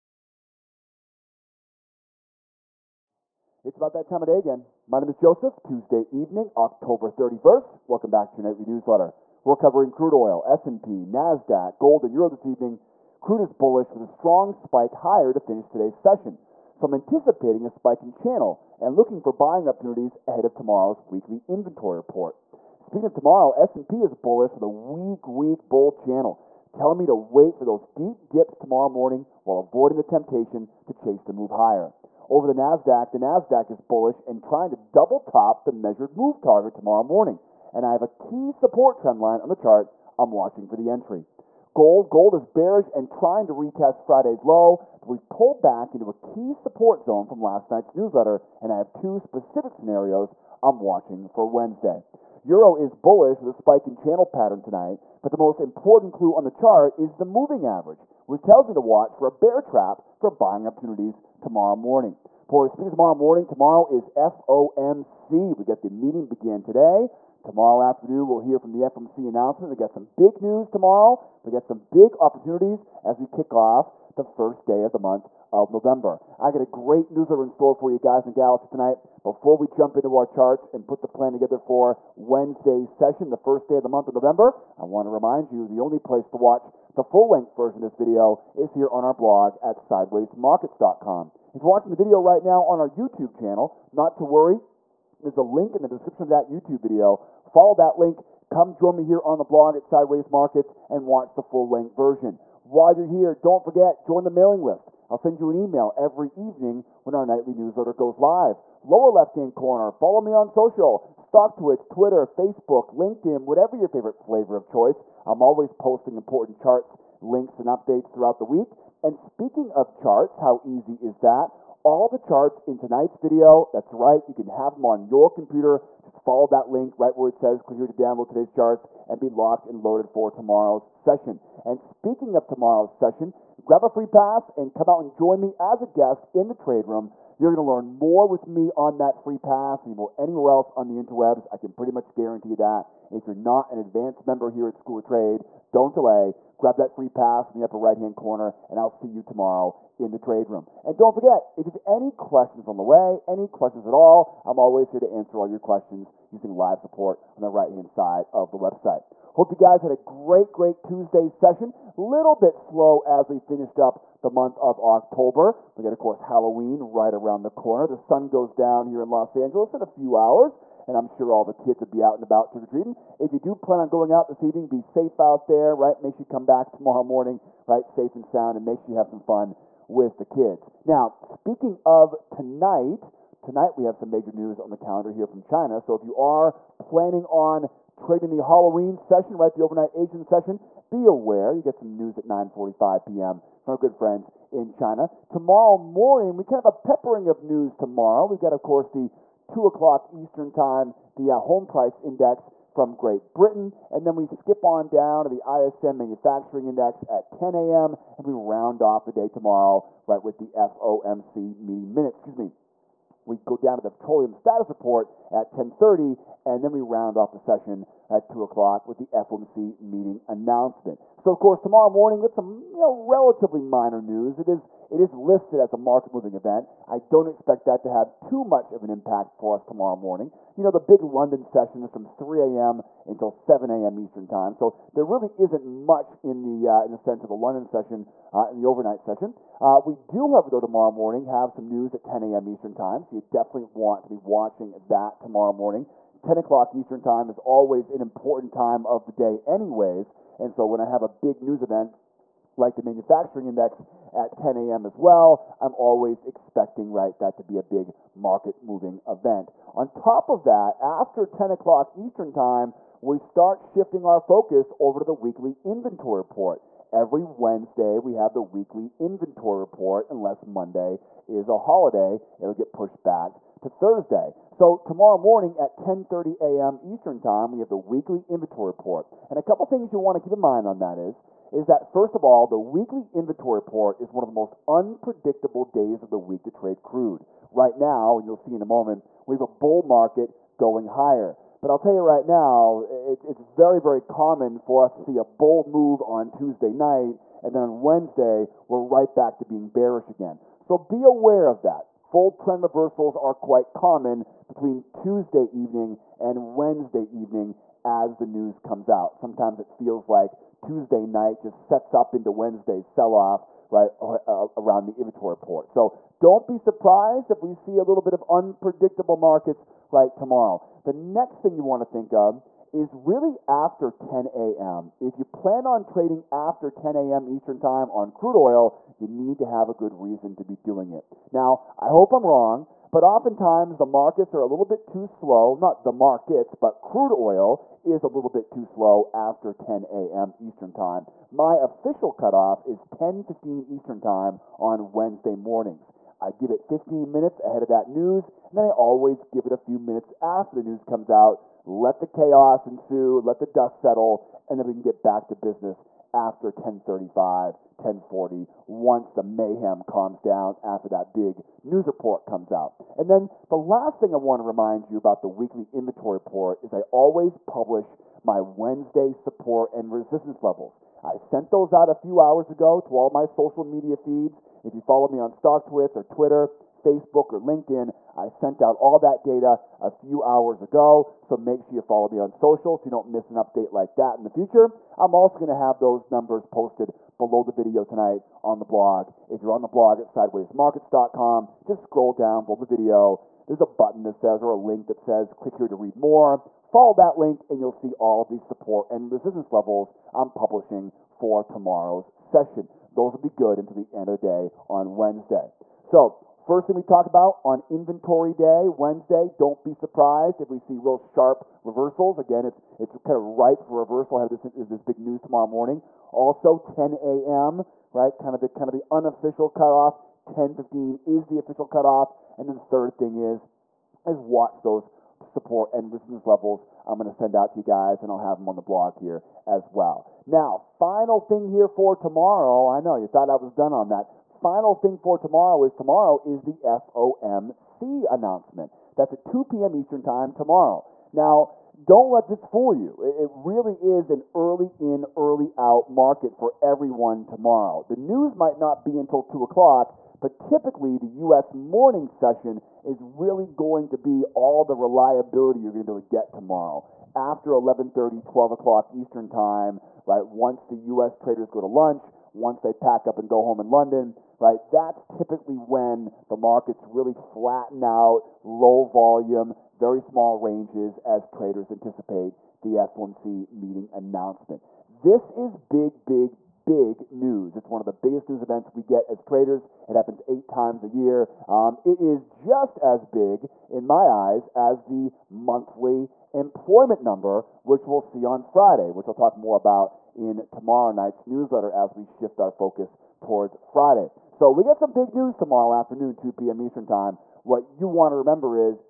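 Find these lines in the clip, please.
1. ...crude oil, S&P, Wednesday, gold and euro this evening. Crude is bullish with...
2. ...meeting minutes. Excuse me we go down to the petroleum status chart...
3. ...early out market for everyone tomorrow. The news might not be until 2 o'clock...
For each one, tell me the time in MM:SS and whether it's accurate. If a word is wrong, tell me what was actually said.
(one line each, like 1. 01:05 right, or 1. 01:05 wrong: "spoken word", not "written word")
1. 00:09 wrong: "Nasdaq", not "Wednesday"
2. 03:31 wrong: "report", not "chart"
3. 07:25 right.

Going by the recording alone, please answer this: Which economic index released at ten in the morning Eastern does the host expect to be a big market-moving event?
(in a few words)
ISM Manufacturing Index.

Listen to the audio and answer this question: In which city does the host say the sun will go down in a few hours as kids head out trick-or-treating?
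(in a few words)
Los Angeles.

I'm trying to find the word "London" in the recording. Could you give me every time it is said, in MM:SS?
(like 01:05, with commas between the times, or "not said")
03:51, 03:57, 07:43.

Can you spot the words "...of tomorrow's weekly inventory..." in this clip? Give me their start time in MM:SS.
00:20.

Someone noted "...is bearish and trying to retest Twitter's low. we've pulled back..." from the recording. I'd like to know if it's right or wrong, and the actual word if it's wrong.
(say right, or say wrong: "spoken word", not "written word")
wrong: "Friday", not "Twitter".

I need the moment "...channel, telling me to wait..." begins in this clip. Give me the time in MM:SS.
00:25.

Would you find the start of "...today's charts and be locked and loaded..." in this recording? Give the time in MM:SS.
02:08.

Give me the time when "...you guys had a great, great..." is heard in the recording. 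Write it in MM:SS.
02:39.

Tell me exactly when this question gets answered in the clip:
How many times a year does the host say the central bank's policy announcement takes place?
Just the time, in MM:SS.
08:00.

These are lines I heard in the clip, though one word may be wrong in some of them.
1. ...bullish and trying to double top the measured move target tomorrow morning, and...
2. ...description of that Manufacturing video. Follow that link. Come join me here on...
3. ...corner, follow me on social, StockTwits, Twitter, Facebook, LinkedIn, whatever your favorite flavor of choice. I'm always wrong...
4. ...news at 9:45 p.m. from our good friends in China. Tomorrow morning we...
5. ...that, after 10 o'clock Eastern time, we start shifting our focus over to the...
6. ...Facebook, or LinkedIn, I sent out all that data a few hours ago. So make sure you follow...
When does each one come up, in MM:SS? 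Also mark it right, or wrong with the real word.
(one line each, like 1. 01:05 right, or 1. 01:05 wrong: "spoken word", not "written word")
1. 00:33 right
2. 01:35 wrong: "YouTube", not "Manufacturing"
3. 01:49 wrong: "posting", not "wrong"
4. 03:11 right
5. 04:20 right
6. 06:16 right.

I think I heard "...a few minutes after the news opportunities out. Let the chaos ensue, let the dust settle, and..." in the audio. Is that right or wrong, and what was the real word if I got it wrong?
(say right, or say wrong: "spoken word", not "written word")
wrong: "comes", not "opportunities".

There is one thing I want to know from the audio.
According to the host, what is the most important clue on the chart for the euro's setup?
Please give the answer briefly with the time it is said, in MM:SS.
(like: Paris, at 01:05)
the moving average, at 00:57.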